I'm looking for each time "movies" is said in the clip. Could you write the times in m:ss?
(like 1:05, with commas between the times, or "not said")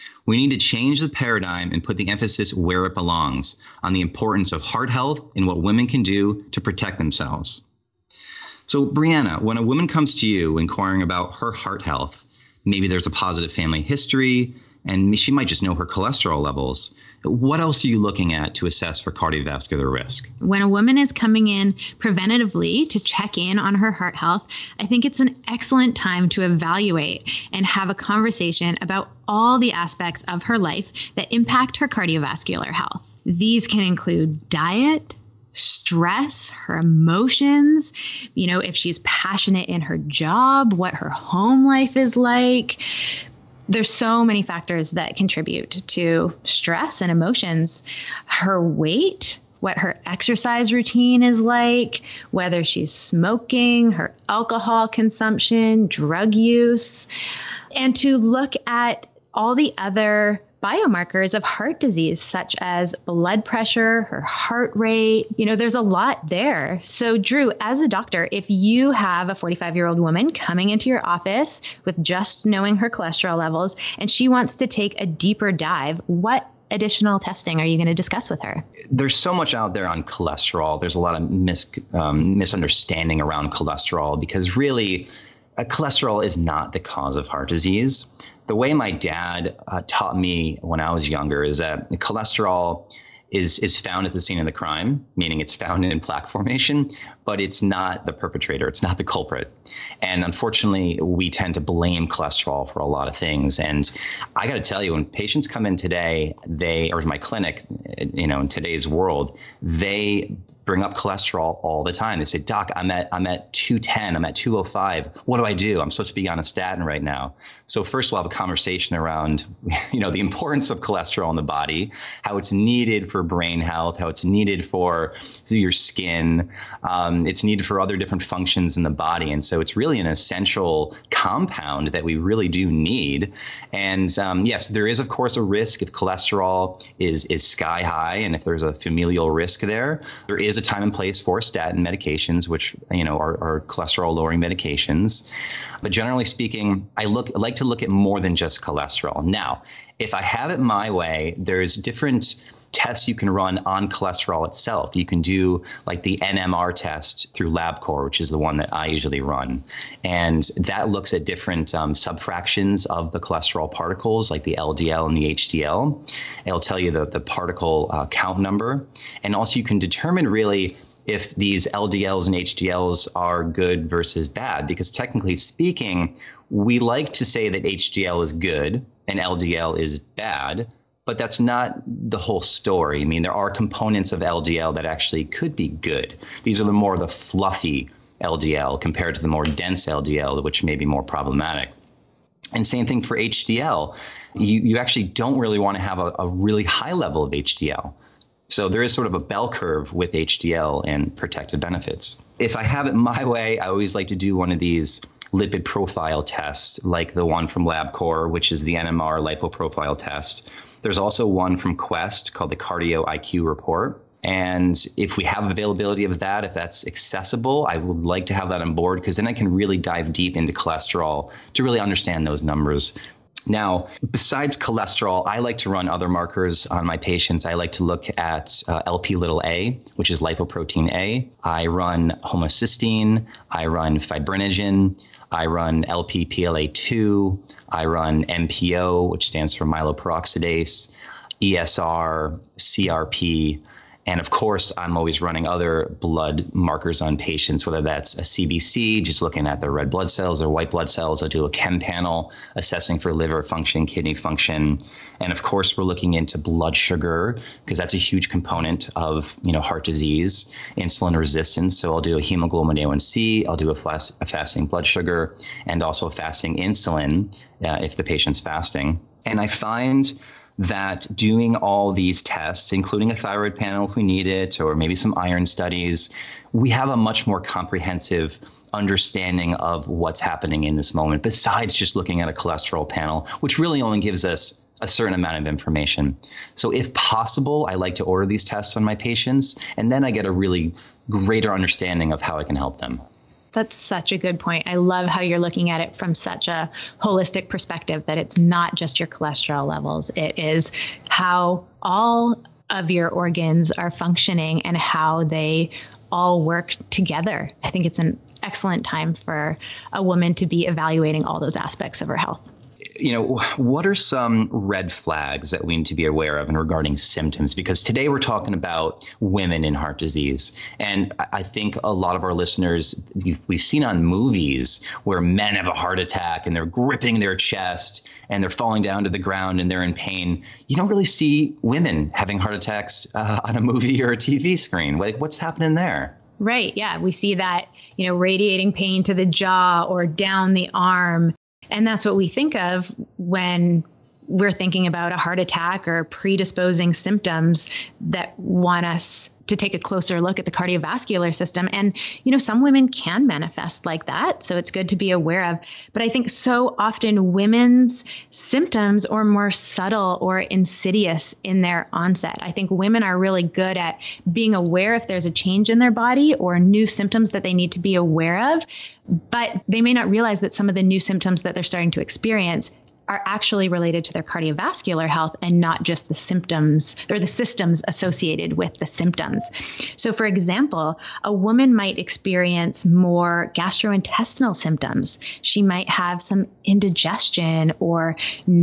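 5:24, 5:33.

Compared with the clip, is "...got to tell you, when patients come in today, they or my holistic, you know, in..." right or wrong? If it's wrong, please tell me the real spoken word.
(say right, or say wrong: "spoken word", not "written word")
wrong: "clinic", not "holistic".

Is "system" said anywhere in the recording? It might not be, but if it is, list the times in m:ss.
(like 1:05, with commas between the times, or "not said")
5:51, 6:17.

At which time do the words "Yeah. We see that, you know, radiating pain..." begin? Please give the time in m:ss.
5:36.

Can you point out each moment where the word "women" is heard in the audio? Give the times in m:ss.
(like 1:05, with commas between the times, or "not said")
0:05, 5:19, 5:31, 5:52, 5:57, 6:02.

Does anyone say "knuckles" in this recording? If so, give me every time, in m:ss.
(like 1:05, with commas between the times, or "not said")
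not said.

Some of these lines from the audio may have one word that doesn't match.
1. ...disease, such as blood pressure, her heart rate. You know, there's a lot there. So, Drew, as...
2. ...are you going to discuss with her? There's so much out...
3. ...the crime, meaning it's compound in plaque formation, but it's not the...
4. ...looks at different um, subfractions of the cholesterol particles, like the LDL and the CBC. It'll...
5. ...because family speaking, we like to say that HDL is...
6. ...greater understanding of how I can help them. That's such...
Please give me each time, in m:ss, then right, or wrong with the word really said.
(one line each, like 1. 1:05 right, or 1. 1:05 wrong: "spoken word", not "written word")
1. 1:01 right
2. 1:17 right
3. 1:34 wrong: "found", not "compound"
4. 2:40 wrong: "HDL", not "CBC"
5. 2:54 wrong: "technically", not "family"
6. 4:51 right.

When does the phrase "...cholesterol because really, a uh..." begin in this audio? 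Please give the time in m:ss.
1:23.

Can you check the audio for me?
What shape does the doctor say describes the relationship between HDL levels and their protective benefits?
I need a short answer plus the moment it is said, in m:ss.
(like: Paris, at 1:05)
bell curve, at 3:19.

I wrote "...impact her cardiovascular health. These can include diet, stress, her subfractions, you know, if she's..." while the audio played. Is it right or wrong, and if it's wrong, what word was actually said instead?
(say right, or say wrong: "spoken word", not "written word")
wrong: "emotions", not "subfractions".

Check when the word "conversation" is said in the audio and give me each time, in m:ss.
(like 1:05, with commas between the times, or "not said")
0:27, 1:58.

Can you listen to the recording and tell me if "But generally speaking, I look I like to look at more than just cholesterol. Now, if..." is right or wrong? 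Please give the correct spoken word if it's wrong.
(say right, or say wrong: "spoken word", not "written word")
right.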